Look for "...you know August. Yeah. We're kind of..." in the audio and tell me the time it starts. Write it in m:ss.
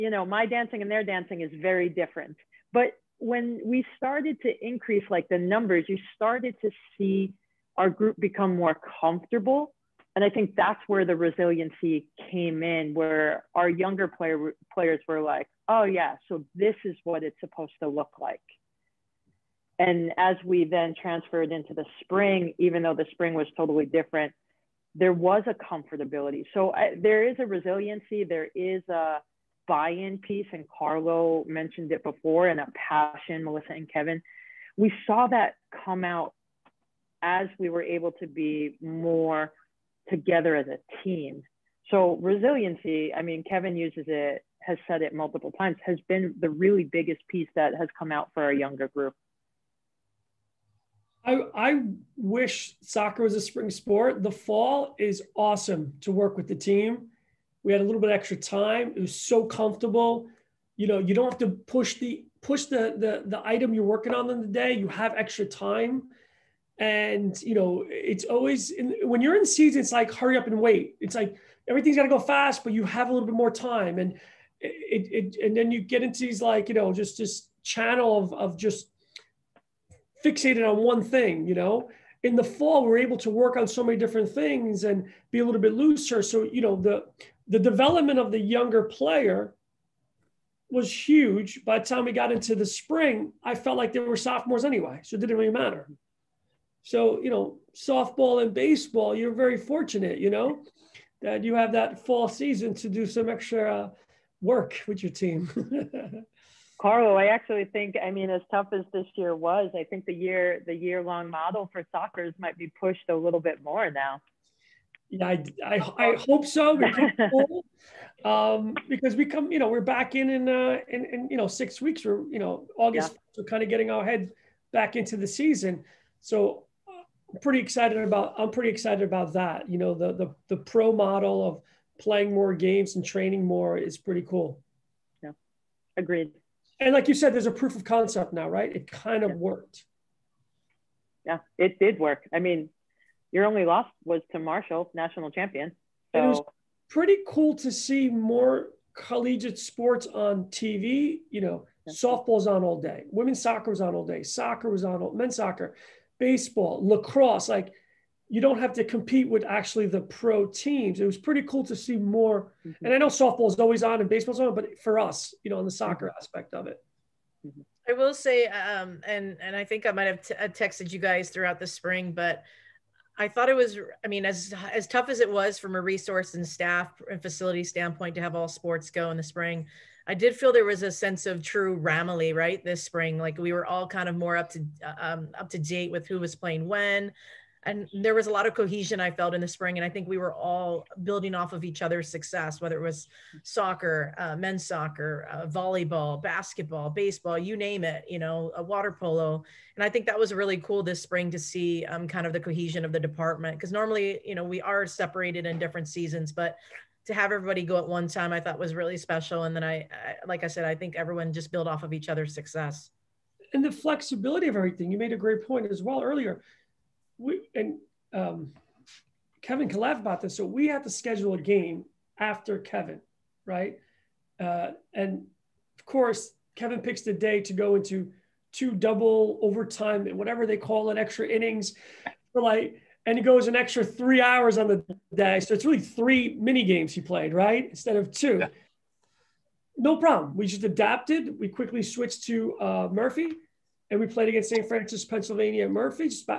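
2:02.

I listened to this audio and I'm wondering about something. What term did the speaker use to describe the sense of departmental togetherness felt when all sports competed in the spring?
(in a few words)
Ramily.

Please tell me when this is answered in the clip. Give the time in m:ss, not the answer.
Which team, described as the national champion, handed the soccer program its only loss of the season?
2:24.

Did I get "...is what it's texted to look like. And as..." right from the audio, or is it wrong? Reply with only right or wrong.
wrong.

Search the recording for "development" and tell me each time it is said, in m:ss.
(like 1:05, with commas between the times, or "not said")
1:27.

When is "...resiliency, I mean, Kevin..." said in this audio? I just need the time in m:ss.
0:42.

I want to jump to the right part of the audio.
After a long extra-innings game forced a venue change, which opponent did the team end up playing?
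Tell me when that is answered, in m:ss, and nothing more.
4:04.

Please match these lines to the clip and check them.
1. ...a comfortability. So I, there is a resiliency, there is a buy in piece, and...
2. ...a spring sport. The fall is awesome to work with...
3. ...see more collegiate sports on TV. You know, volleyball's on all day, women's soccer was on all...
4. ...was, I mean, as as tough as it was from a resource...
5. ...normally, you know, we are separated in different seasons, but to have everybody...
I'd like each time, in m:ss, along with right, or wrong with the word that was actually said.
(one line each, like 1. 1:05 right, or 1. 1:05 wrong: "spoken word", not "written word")
1. 0:25 right
2. 0:53 right
3. 2:27 wrong: "softball", not "volleyball"
4. 2:53 right
5. 3:23 right.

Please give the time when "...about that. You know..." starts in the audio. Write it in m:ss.
2:09.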